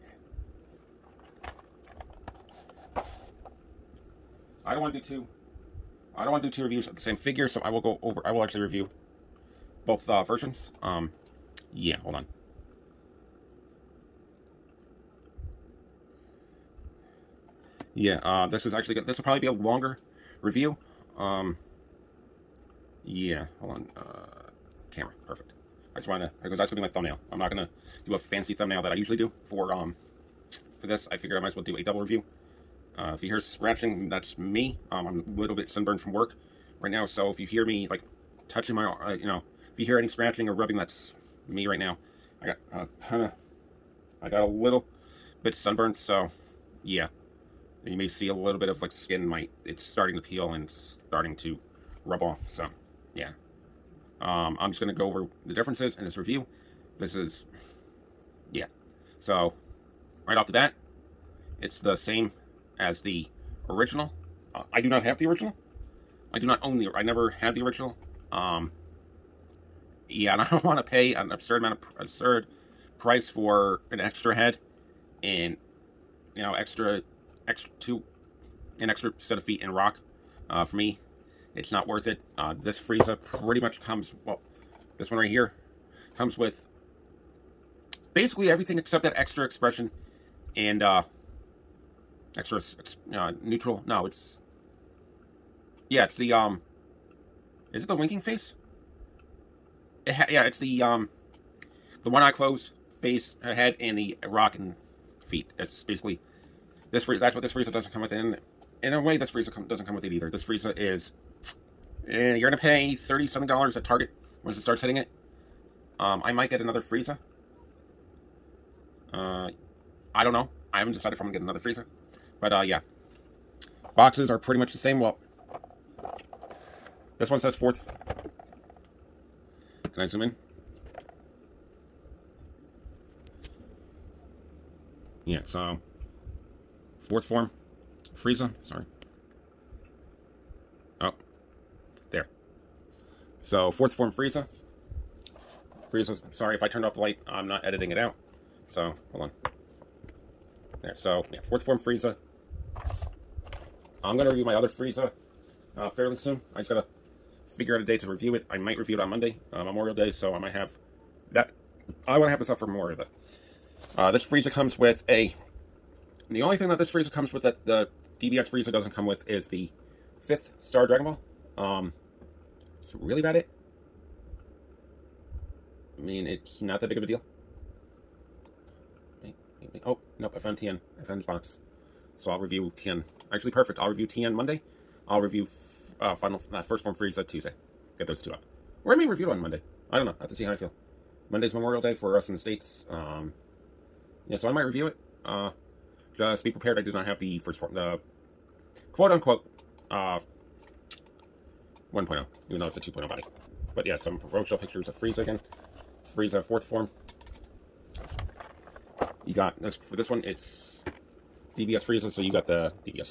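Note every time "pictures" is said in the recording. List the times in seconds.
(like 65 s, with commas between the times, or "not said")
204 s.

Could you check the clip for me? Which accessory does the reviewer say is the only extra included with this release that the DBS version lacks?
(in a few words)
fifth Star Dragon Ball.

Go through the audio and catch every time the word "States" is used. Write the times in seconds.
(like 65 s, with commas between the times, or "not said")
192 s.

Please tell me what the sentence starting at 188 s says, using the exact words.
Or I may review it on Monday.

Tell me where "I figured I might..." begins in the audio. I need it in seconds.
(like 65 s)
31 s.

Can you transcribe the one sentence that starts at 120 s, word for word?
I haven't decided if I'm going to get another Frieza.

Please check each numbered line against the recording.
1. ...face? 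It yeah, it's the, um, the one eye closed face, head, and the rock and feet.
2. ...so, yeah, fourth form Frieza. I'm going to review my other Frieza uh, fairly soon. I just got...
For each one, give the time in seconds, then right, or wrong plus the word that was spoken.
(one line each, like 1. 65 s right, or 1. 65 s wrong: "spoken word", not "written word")
1. 98 s right
2. 150 s right.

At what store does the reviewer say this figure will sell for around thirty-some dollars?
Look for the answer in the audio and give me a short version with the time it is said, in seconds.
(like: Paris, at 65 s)
Target, at 113 s.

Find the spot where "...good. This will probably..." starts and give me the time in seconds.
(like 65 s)
18 s.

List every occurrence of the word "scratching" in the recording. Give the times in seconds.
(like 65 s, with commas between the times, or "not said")
33 s, 40 s.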